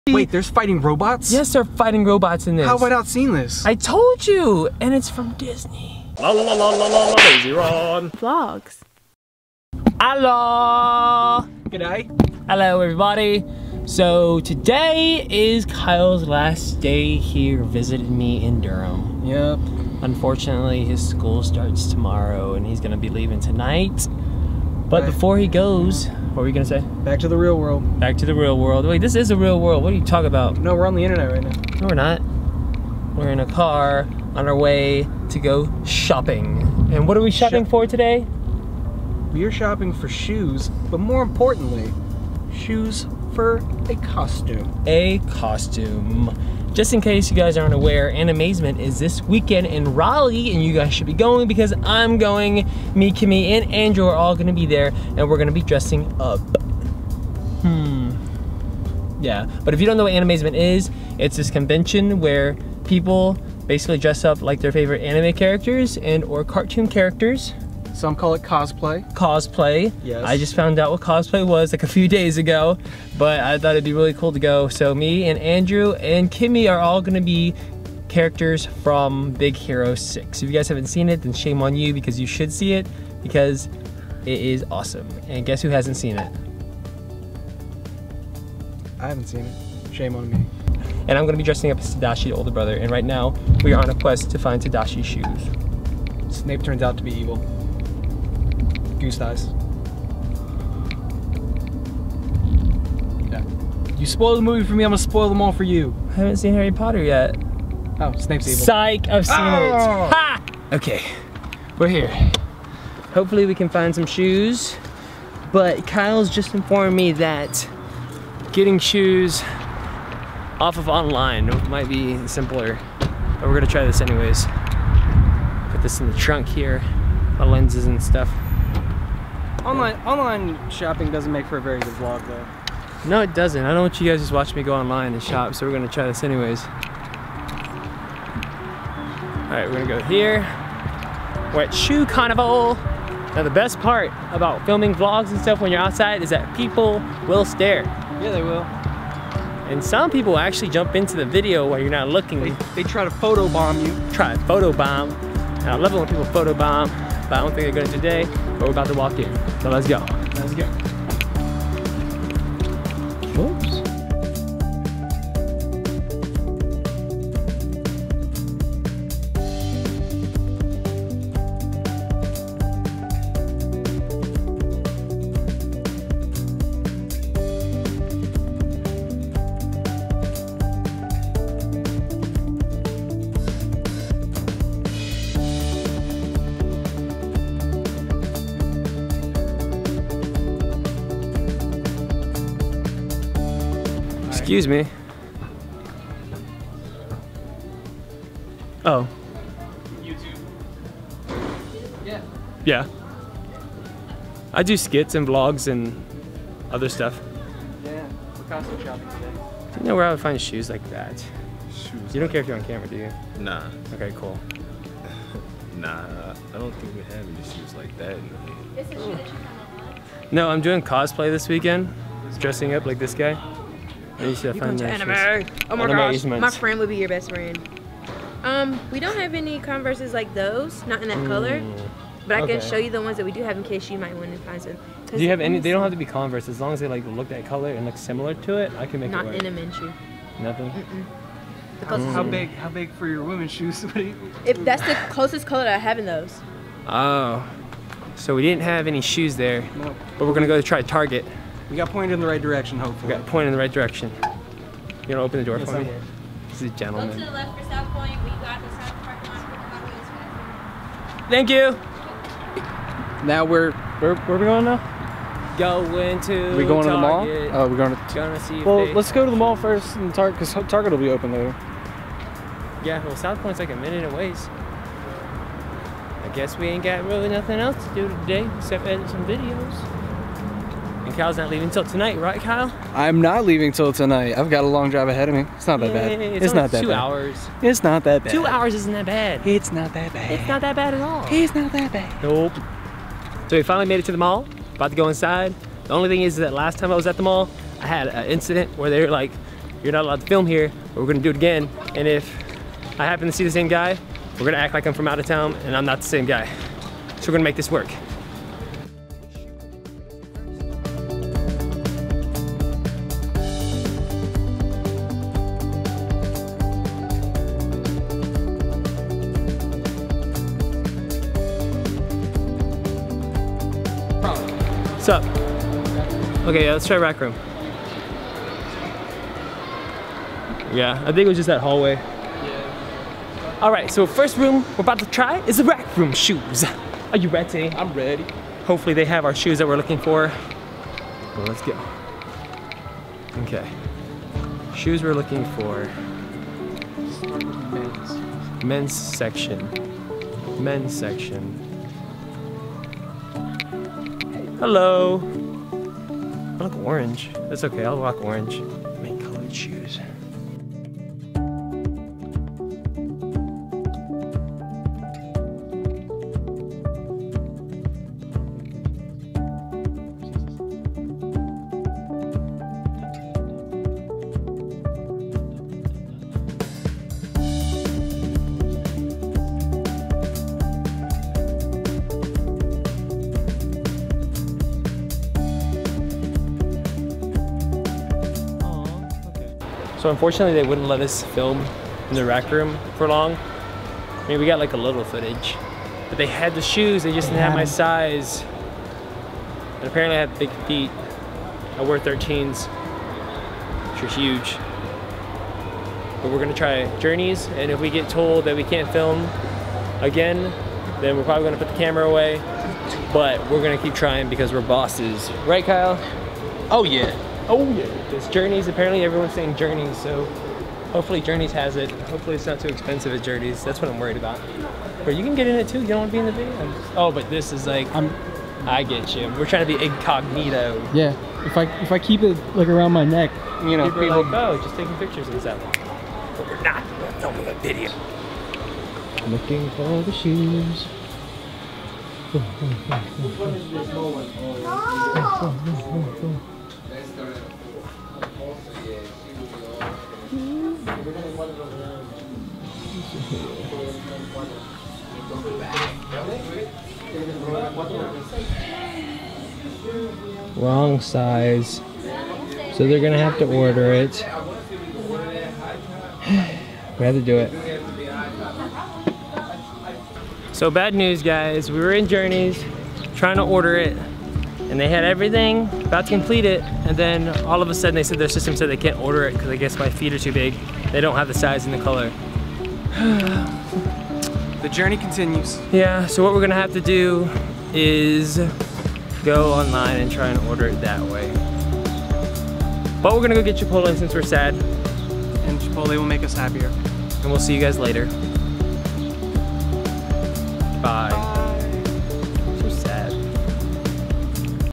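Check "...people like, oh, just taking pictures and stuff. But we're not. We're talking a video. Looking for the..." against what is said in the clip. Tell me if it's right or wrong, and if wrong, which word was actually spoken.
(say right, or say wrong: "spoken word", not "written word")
wrong: "filming", not "talking".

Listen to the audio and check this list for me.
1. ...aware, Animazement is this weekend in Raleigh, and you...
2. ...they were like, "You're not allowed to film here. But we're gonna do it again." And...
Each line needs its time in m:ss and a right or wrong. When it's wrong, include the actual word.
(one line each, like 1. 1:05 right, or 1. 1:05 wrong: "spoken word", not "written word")
1. 0:47 right
2. 4:58 right.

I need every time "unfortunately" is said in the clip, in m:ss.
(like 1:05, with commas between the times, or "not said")
0:20, 6:30.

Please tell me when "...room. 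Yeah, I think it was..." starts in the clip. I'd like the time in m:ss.
5:27.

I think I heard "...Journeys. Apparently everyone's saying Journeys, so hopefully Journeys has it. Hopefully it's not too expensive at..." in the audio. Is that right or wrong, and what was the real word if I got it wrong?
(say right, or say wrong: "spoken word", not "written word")
right.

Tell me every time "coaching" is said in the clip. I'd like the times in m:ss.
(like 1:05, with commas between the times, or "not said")
not said.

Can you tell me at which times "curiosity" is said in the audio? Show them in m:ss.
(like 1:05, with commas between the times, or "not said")
not said.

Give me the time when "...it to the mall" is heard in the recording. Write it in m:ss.
4:53.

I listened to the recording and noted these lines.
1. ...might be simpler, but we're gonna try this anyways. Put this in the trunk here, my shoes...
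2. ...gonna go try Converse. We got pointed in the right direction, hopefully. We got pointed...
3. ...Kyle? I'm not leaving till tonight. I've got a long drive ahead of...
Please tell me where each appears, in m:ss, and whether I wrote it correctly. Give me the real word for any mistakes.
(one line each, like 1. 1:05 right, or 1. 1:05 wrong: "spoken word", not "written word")
1. 2:01 wrong: "lenses", not "shoes"
2. 4:10 wrong: "Target", not "Converse"
3. 4:42 right.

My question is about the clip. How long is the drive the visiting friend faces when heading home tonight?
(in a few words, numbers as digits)
2 hours.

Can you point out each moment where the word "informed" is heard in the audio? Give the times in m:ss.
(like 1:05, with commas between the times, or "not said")
1:56.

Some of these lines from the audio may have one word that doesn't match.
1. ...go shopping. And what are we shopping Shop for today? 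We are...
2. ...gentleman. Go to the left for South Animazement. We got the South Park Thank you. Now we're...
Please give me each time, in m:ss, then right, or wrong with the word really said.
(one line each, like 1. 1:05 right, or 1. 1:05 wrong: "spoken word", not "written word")
1. 0:35 right
2. 4:16 wrong: "Point", not "Animazement".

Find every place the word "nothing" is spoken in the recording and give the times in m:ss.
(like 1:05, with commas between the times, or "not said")
4:00, 4:37.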